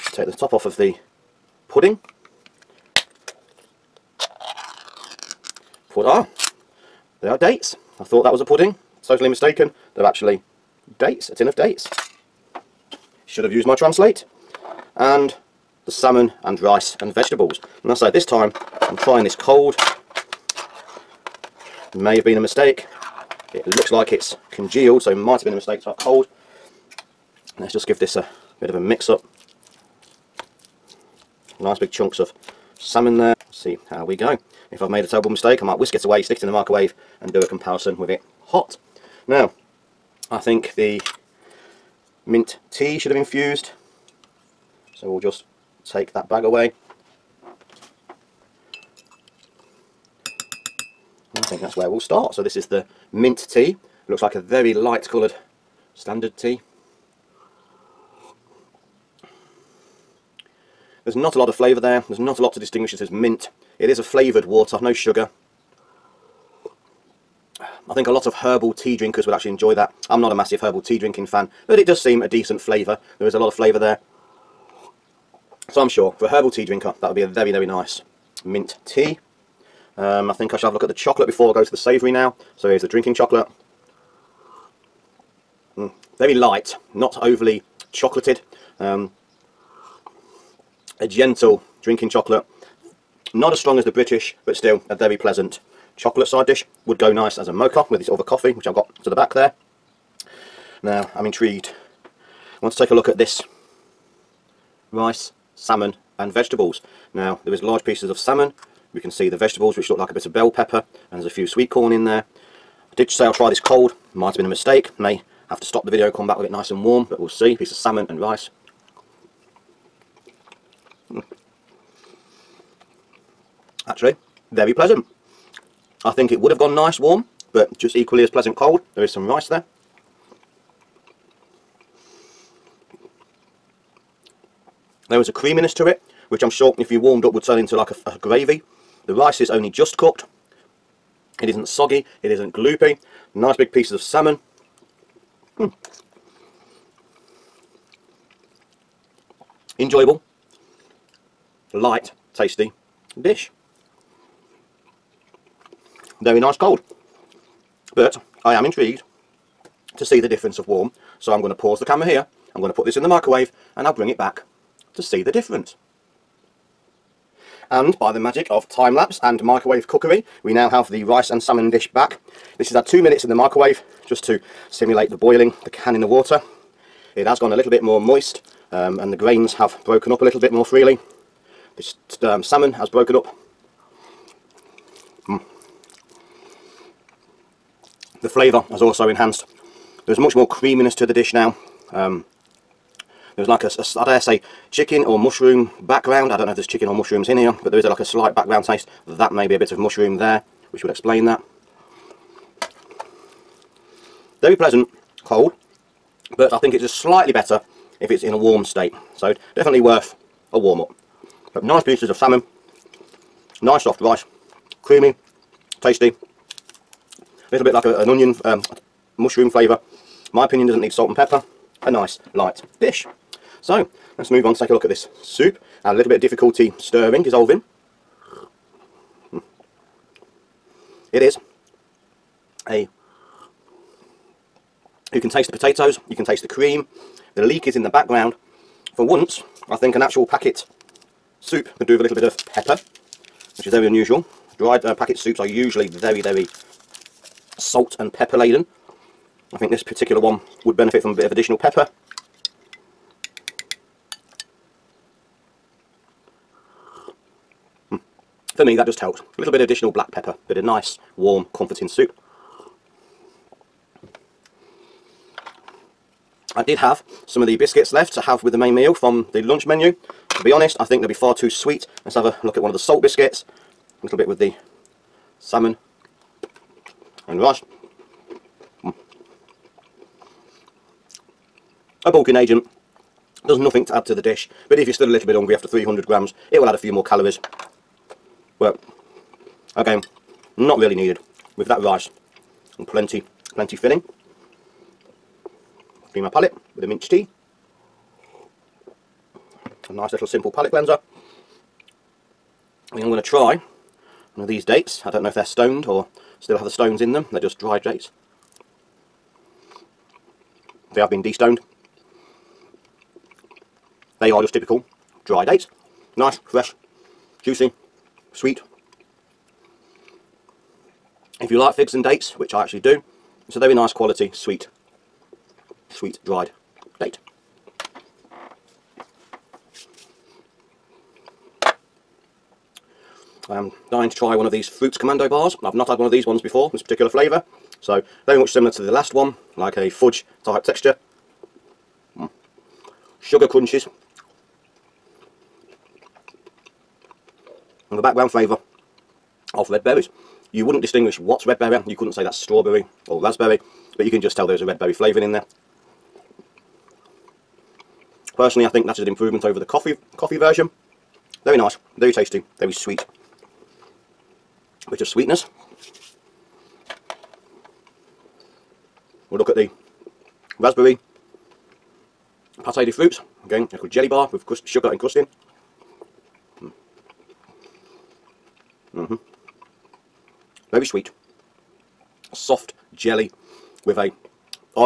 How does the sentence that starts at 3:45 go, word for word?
had a little bit of difficulty stirring, dissolving.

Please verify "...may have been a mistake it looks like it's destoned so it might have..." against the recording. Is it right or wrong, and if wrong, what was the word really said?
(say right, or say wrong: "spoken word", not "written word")
wrong: "congealed", not "destoned".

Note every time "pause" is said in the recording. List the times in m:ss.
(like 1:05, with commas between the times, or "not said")
2:41.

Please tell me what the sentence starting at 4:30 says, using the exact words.
To be honest, I think they'll be far too sweet.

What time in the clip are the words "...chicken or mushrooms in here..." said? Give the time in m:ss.
3:16.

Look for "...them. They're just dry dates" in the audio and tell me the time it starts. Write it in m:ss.
5:07.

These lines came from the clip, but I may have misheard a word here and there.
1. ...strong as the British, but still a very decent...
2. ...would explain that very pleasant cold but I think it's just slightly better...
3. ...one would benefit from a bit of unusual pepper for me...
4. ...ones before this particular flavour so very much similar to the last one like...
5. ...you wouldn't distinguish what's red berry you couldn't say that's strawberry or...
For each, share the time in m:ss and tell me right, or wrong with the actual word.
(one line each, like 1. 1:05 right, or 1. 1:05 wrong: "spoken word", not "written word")
1. 1:33 wrong: "pleasant", not "decent"
2. 3:20 right
3. 4:10 wrong: "additional", not "unusual"
4. 5:36 right
5. 5:50 right.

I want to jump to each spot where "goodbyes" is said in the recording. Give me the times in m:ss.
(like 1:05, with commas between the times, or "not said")
not said.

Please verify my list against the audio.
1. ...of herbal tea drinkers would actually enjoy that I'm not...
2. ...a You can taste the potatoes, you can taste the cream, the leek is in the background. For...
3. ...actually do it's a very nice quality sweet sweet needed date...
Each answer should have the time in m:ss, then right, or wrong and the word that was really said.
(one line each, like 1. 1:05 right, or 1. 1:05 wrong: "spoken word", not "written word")
1. 1:08 right
2. 3:52 right
3. 5:22 wrong: "dried", not "needed".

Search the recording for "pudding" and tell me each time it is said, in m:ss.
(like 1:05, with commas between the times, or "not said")
0:01, 0:08.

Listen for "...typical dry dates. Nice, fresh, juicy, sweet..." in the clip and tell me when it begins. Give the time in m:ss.
5:14.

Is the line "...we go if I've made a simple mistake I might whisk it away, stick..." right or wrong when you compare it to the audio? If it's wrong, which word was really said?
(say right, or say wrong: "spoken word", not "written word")
wrong: "terrible", not "simple".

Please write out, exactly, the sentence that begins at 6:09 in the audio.
We'll look at the raspberry pate de fruits.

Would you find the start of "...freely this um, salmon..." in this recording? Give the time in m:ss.
3:00.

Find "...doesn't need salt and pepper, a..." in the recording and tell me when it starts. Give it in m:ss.
3:40.